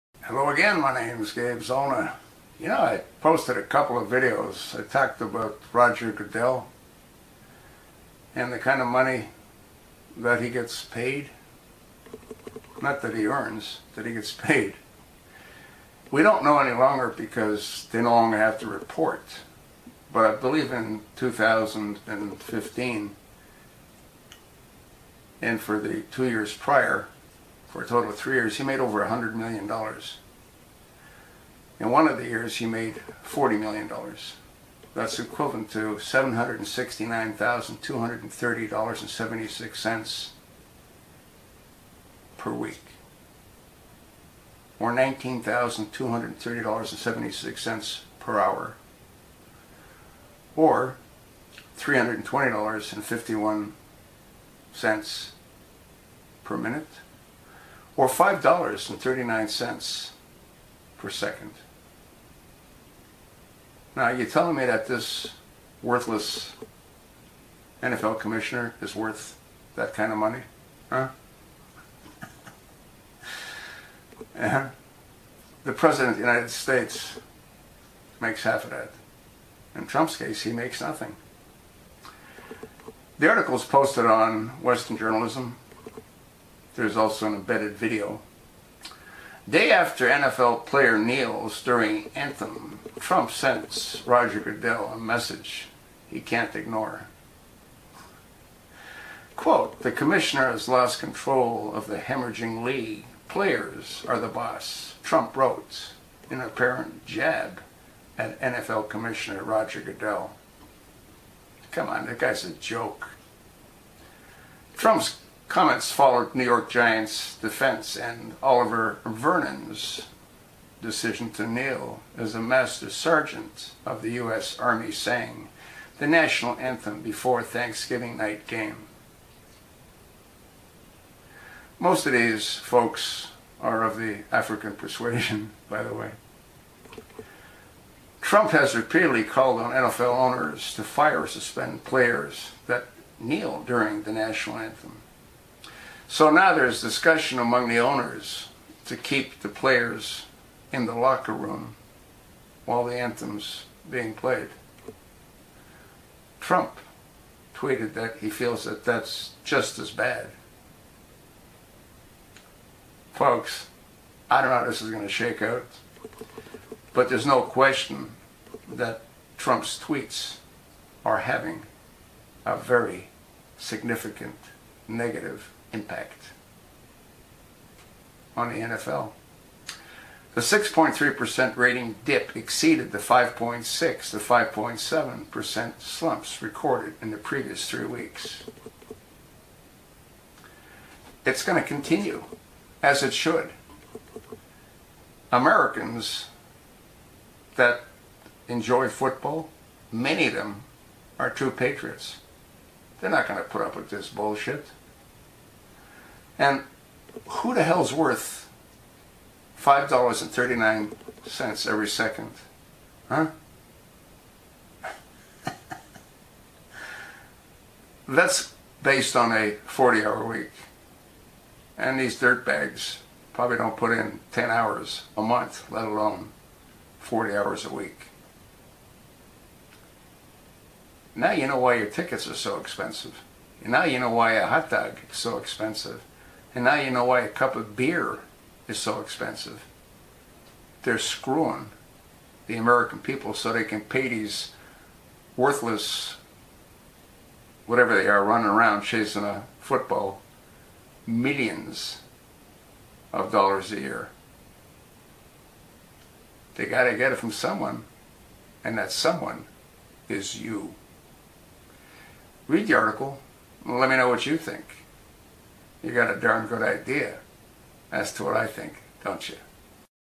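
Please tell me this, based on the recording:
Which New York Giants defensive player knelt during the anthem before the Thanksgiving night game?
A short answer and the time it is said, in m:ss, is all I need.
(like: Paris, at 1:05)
Oliver Vernon, at 1:58.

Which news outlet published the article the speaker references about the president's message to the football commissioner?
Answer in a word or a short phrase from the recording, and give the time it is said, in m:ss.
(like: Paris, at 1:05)
Western Journalism, at 1:24.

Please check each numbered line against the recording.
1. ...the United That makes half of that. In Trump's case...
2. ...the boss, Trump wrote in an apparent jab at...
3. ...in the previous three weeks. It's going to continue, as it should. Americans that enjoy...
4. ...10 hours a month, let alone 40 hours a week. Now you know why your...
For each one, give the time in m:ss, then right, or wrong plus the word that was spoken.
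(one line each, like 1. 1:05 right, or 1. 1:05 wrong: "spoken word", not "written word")
1. 1:16 wrong: "States", not "That"
2. 1:44 right
3. 3:07 right
4. 3:44 right.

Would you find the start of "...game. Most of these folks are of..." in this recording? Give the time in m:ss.
2:08.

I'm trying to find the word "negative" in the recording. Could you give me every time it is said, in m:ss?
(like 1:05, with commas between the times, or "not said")
2:54.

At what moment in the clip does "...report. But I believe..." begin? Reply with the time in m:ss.
0:18.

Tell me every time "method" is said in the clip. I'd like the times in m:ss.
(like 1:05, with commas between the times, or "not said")
not said.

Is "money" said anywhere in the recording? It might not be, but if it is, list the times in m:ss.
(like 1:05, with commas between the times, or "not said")
0:08, 1:10.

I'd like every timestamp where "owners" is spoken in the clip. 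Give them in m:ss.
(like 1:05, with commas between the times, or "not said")
2:20, 2:27.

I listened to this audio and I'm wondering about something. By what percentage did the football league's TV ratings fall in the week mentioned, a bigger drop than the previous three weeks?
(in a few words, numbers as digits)
6.3%.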